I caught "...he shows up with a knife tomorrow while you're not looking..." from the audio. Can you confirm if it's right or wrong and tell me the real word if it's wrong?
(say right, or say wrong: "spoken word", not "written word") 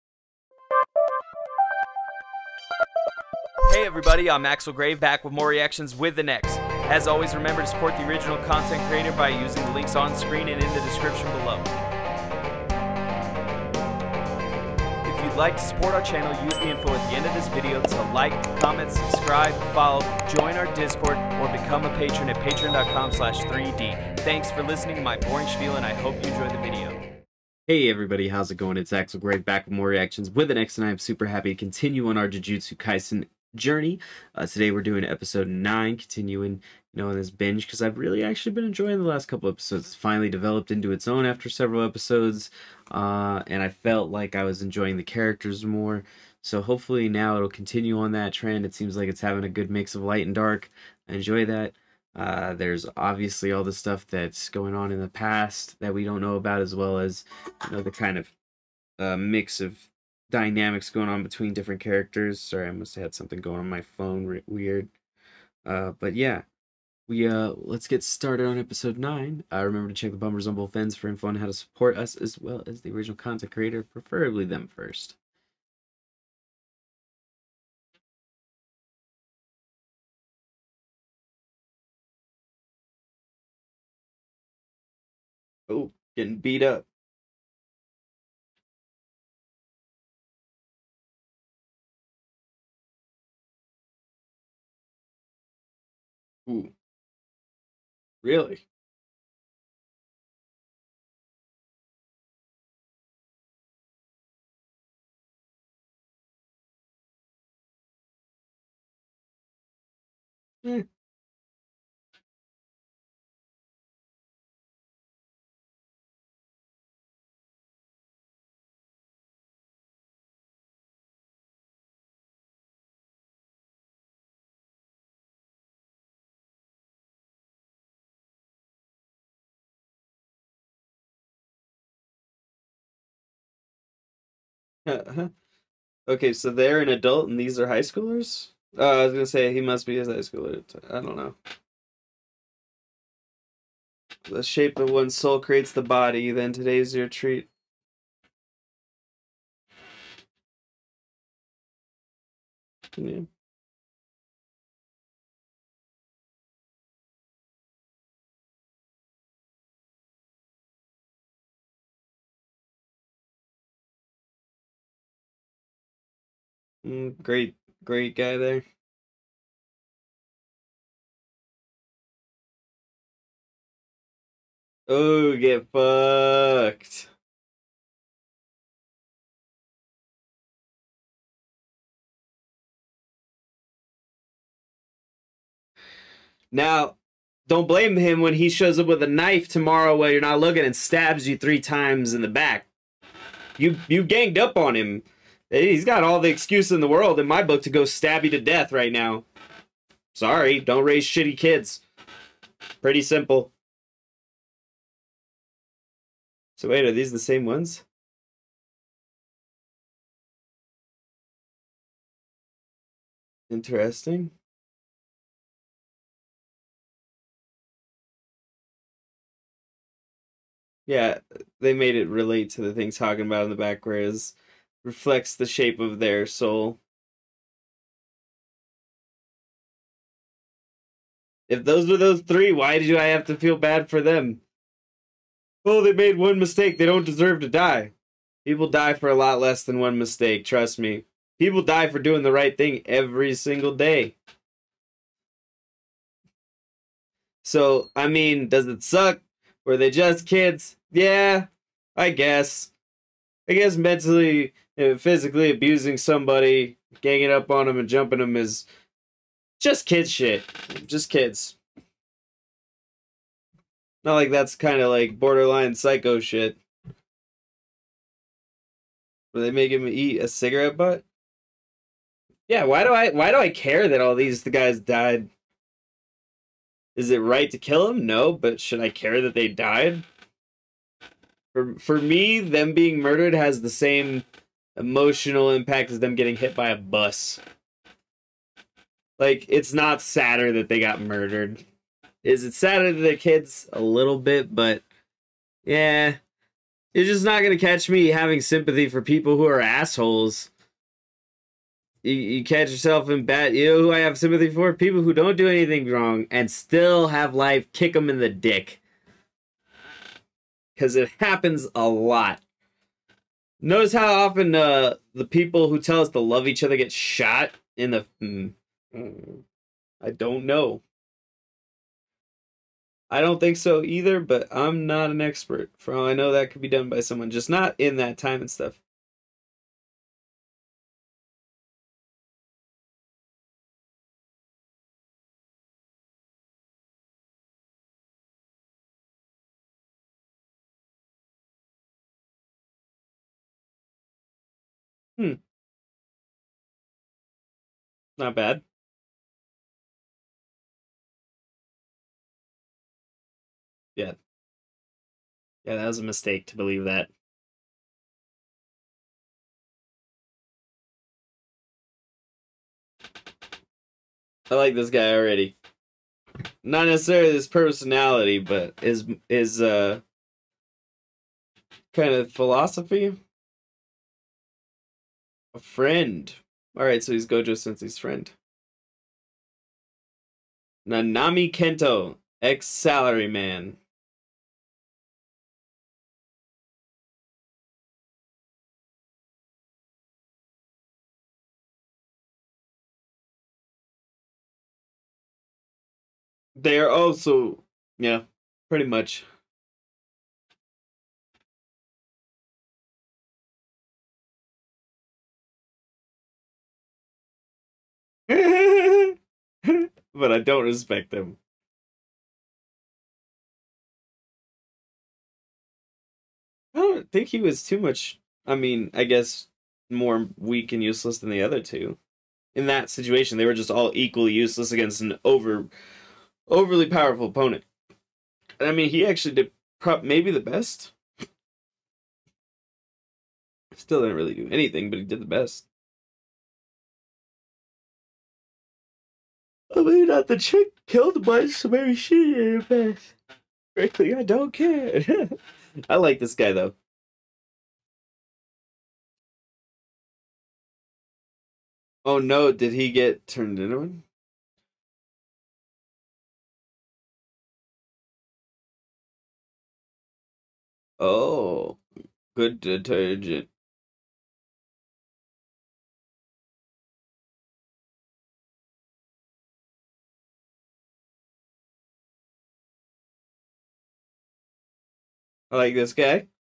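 right.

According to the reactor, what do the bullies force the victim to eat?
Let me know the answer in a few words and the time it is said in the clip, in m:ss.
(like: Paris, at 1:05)
cigarette butt, at 4:30.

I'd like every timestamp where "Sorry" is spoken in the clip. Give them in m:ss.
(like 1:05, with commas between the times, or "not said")
1:02, 3:20.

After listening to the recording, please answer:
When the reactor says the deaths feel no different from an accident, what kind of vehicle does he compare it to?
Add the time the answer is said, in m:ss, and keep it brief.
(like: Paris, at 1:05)
bus, at 4:46.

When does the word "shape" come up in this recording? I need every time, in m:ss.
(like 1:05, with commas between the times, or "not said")
2:24, 3:45.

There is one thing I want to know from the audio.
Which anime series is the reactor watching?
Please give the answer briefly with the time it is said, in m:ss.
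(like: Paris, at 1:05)
Jujutsu Kaisen, at 0:32.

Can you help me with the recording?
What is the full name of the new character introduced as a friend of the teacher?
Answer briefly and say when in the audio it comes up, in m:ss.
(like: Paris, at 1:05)
Nanami Kento, at 6:20.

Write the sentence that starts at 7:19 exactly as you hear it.
I mean, not the chick killed so maybe she did it Frankly, I don't care.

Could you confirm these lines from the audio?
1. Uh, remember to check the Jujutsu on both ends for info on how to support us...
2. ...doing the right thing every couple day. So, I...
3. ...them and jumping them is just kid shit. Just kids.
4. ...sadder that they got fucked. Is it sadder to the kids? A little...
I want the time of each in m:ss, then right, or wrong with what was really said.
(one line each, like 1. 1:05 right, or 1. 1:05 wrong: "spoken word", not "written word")
1. 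1:09 wrong: "Bummers", not "Jujutsu"
2. 4:01 wrong: "single", not "couple"
3. 4:17 right
4. 4:49 wrong: "murdered", not "fucked".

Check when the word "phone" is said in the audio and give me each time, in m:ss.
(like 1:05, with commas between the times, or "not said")
1:03.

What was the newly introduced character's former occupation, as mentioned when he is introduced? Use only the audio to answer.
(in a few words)
salaryman.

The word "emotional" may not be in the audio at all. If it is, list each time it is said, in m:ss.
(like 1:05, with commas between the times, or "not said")
4:44.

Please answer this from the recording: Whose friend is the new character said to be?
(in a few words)
Gojo Sensei.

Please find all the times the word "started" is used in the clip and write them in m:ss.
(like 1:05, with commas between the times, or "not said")
1:08.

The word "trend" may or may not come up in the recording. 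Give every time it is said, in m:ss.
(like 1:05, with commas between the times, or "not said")
0:48.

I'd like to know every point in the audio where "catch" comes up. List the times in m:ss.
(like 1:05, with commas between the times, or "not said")
4:57, 5:02.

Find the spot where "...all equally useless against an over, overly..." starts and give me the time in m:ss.
7:03.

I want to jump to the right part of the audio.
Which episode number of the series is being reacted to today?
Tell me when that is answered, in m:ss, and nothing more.
0:35.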